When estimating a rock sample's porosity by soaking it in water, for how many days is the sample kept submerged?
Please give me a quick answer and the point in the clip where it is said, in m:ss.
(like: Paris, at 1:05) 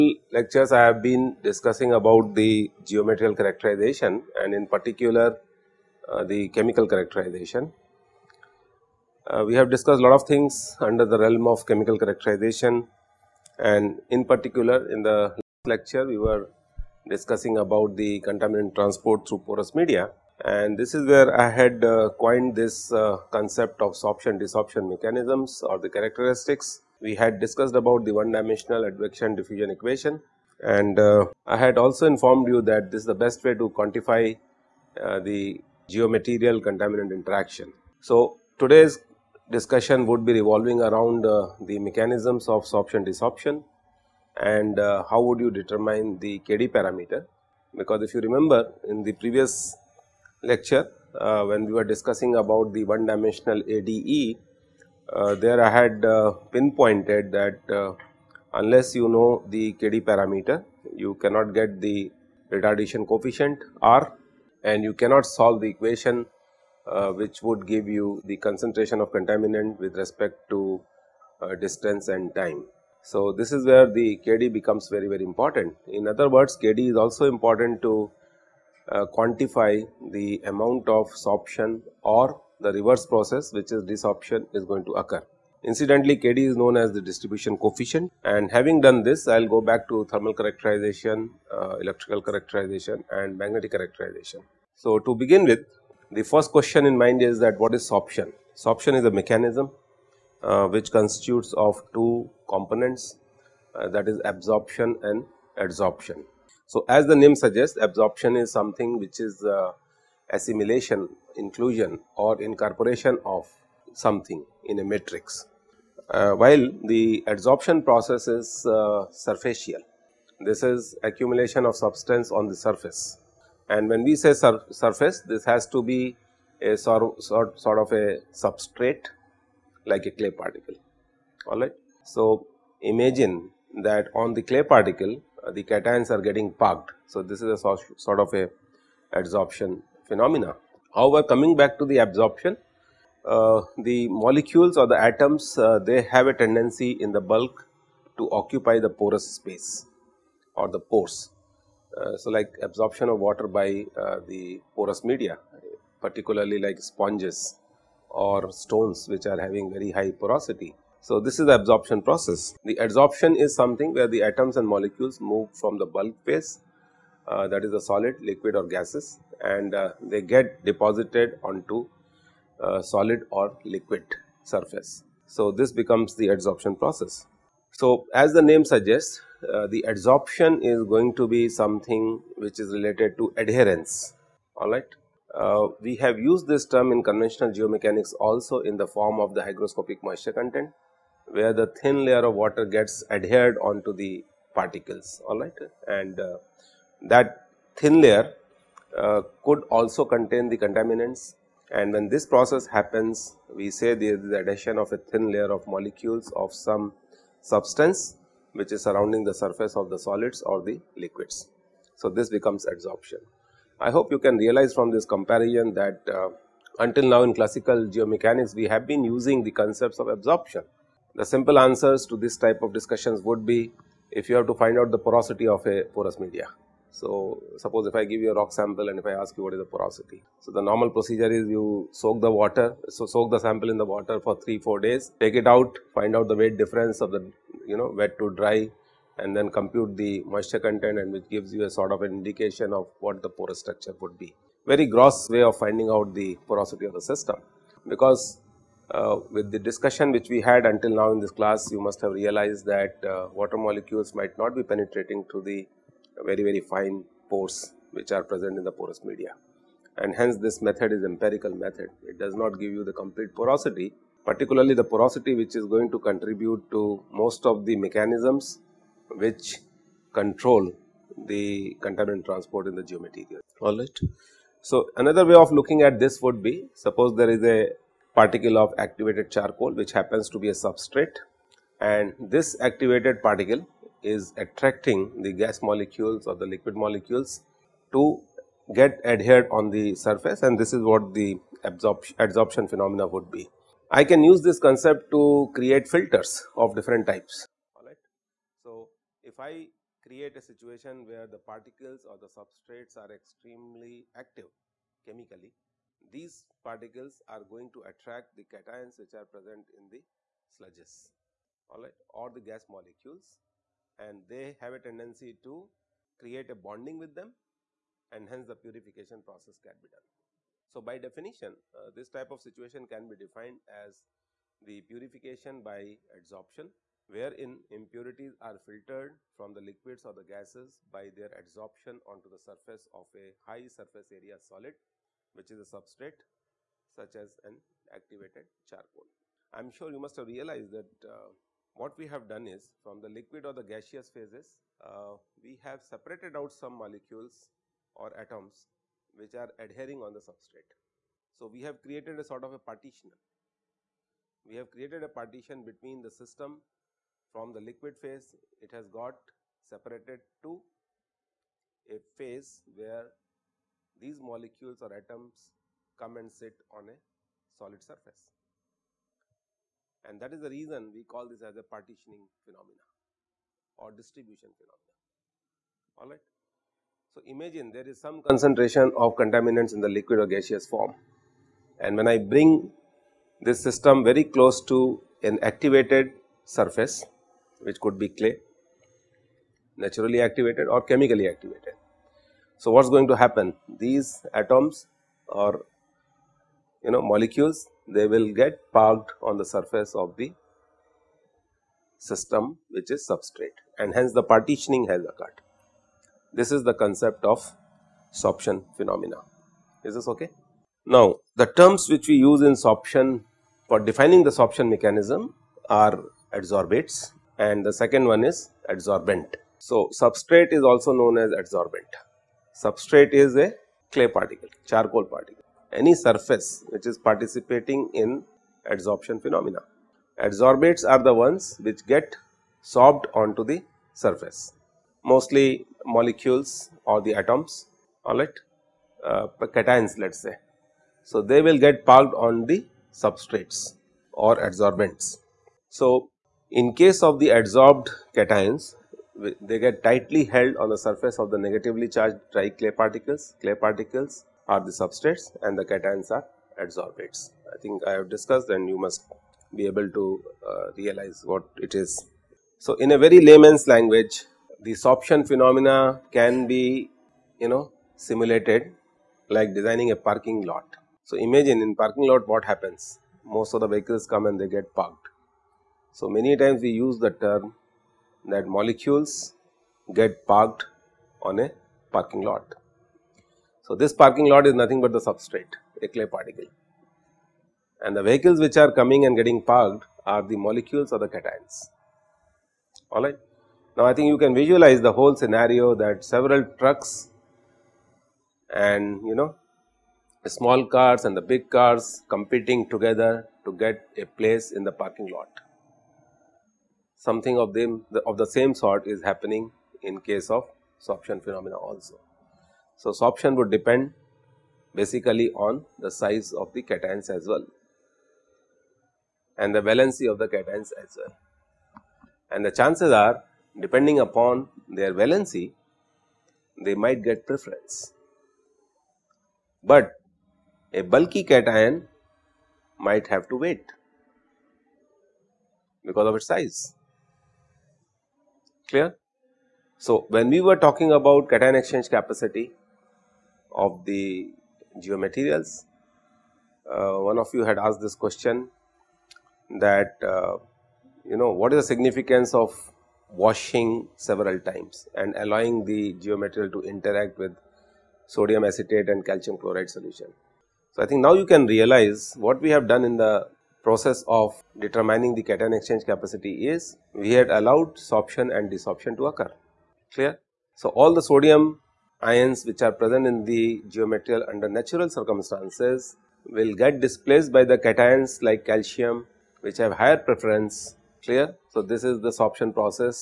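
3-4 days, at 3:54.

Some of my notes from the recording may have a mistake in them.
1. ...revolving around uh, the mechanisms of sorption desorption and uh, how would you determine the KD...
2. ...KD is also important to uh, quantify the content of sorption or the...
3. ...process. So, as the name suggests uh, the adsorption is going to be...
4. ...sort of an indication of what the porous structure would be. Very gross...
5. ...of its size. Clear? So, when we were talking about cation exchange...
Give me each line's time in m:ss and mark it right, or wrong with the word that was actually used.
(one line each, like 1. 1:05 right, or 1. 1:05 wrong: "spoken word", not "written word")
1. 0:40 right
2. 1:16 wrong: "amount", not "content"
3. 2:56 right
4. 4:01 right
5. 8:56 right.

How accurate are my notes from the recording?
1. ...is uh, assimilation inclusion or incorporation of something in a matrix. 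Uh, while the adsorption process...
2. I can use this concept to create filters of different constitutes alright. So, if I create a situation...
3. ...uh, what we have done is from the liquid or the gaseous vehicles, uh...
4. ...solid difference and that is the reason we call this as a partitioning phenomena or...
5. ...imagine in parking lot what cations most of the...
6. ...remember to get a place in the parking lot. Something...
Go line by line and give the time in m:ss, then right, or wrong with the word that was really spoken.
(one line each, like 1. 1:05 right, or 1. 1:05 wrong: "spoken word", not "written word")
1. 1:49 right
2. 4:53 wrong: "types", not "constitutes"
3. 5:41 wrong: "phases", not "vehicles"
4. 6:07 wrong: "surface", not "difference"
5. 7:51 wrong: "happens", not "cations"
6. 8:22 wrong: "together", not "remember".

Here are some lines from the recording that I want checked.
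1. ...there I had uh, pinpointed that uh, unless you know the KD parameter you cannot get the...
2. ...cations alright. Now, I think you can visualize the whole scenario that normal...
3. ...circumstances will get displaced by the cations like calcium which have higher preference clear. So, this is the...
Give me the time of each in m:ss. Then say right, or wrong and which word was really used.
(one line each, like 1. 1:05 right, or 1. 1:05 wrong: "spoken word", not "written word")
1. 0:55 right
2. 8:11 wrong: "several", not "normal"
3. 9:34 right.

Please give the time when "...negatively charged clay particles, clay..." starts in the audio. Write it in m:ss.
7:31.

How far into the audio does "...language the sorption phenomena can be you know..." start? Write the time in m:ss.
7:43.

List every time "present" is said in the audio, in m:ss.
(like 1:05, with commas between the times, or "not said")
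4:18, 5:09, 9:32.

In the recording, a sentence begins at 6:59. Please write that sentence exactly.
So, substrate is also known as adsorbent.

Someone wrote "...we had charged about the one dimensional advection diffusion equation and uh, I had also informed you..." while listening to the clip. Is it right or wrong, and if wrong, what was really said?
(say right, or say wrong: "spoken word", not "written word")
wrong: "discussed", not "charged".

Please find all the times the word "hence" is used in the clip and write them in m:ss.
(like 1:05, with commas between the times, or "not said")
4:20, 5:18, 6:43.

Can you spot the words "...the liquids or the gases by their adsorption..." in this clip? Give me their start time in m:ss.
5:29.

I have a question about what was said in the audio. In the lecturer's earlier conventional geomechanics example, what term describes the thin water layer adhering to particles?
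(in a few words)
hygroscopic moisture content.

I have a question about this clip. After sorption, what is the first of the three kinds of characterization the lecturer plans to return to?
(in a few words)
thermal characterization.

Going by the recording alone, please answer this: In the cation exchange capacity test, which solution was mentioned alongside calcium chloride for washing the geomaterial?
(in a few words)
sodium acetate.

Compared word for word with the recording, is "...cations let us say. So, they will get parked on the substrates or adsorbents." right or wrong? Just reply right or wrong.
right.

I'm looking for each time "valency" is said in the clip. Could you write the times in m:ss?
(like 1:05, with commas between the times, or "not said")
8:39, 8:44.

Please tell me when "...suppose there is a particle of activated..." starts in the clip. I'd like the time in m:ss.
4:36.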